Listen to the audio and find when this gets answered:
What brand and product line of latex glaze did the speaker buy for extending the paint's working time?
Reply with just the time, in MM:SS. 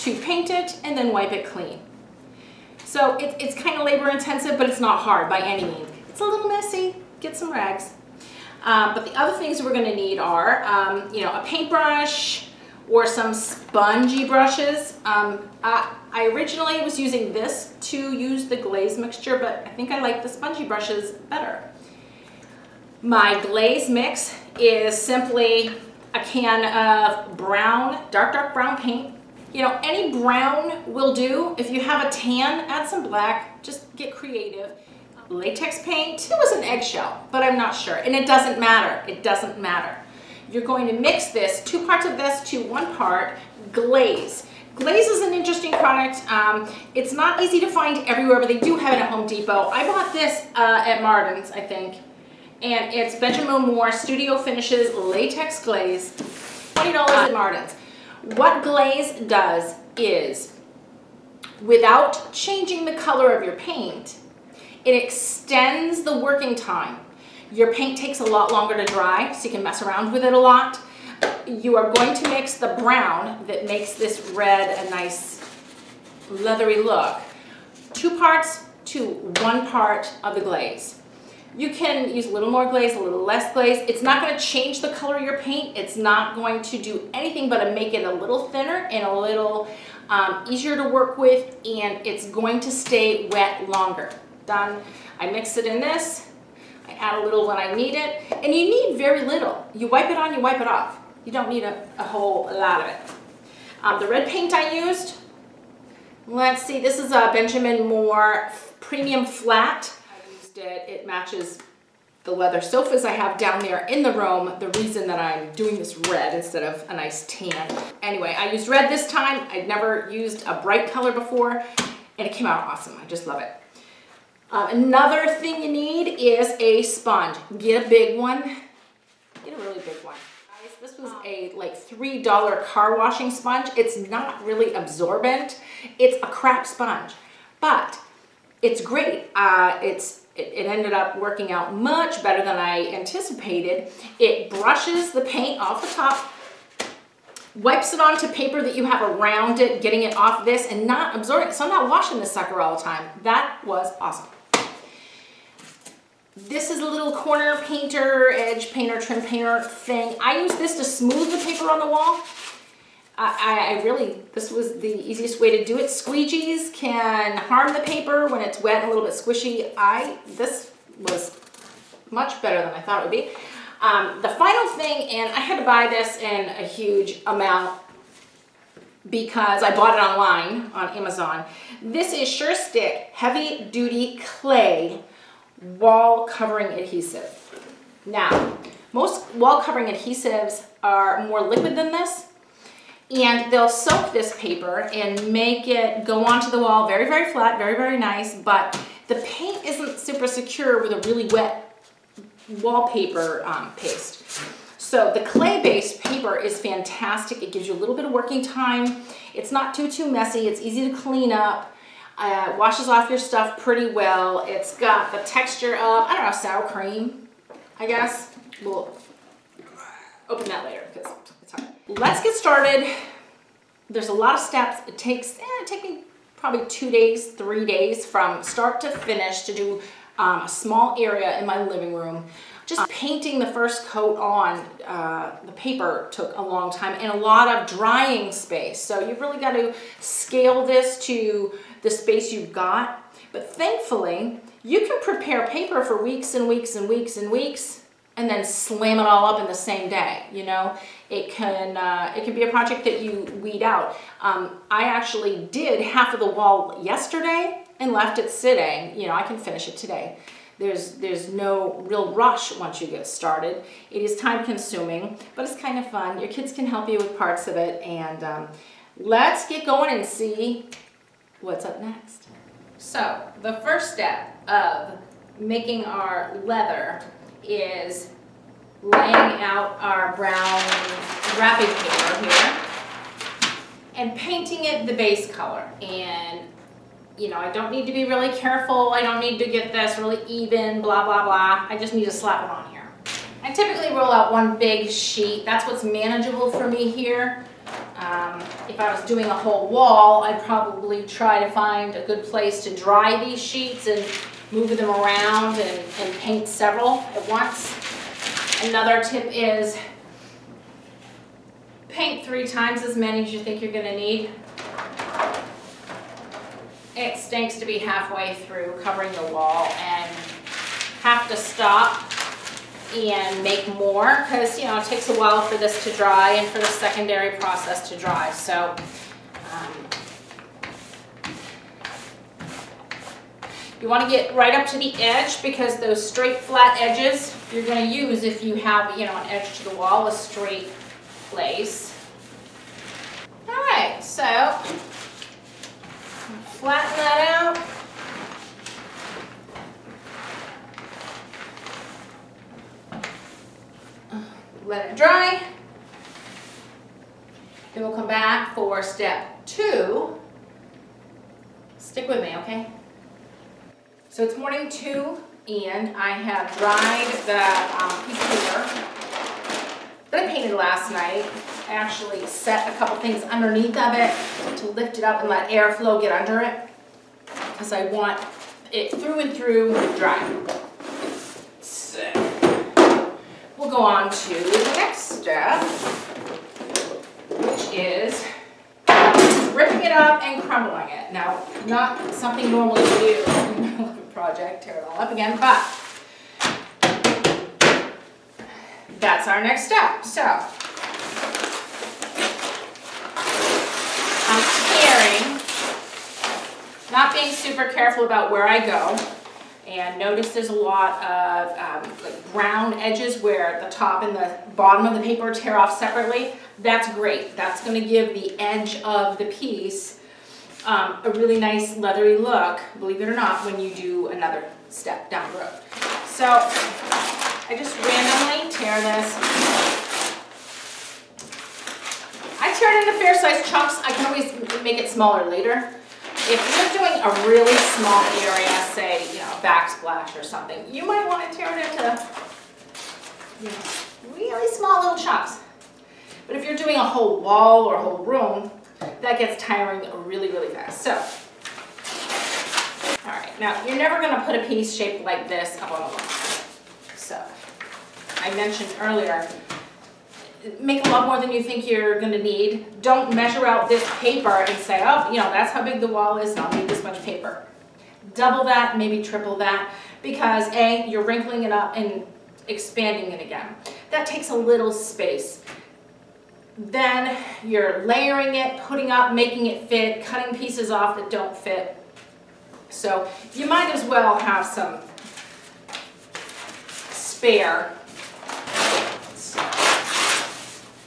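00:53.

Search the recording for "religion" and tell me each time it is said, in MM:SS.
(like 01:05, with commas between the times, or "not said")
not said.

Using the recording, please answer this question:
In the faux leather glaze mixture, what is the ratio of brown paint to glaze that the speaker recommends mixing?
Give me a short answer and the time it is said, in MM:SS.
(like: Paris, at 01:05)
2 parts to 1 part, at 00:41.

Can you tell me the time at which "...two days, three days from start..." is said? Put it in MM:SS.
03:46.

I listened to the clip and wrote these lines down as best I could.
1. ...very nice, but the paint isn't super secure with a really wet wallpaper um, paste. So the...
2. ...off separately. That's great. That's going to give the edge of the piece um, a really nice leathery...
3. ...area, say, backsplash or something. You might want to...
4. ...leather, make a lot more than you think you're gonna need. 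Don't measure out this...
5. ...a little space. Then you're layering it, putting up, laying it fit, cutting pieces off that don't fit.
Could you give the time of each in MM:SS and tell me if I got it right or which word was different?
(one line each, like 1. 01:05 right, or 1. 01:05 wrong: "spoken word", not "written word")
1. 03:17 right
2. 06:55 right
3. 07:18 right
4. 07:38 wrong: "earlier", not "leather"
5. 07:54 wrong: "making", not "laying".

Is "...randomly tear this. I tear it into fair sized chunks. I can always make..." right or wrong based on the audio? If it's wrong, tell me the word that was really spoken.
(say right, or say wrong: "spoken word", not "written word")
right.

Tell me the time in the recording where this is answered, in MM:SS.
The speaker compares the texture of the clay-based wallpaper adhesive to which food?
03:36.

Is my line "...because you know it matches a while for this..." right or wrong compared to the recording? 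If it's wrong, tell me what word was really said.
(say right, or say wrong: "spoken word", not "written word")
wrong: "takes", not "matches".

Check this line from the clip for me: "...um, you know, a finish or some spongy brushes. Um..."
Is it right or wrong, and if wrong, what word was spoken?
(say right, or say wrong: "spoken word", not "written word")
wrong: "paintbrush", not "finish".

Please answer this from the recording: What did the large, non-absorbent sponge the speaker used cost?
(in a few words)
$3.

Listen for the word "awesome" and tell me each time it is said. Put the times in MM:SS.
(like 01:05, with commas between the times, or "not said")
02:02, 02:34.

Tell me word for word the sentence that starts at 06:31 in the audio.
Now, not something normally you do in a project, tear it all up again, but that's our next step.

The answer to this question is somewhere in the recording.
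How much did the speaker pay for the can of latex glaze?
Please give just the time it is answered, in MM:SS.
00:56.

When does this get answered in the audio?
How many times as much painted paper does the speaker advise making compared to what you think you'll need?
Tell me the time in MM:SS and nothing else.
05:12.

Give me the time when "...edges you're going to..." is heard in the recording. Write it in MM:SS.
05:36.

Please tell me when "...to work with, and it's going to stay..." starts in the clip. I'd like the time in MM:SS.
01:30.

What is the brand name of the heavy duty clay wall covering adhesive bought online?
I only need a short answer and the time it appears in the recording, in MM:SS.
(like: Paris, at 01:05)
SureStick, at 03:02.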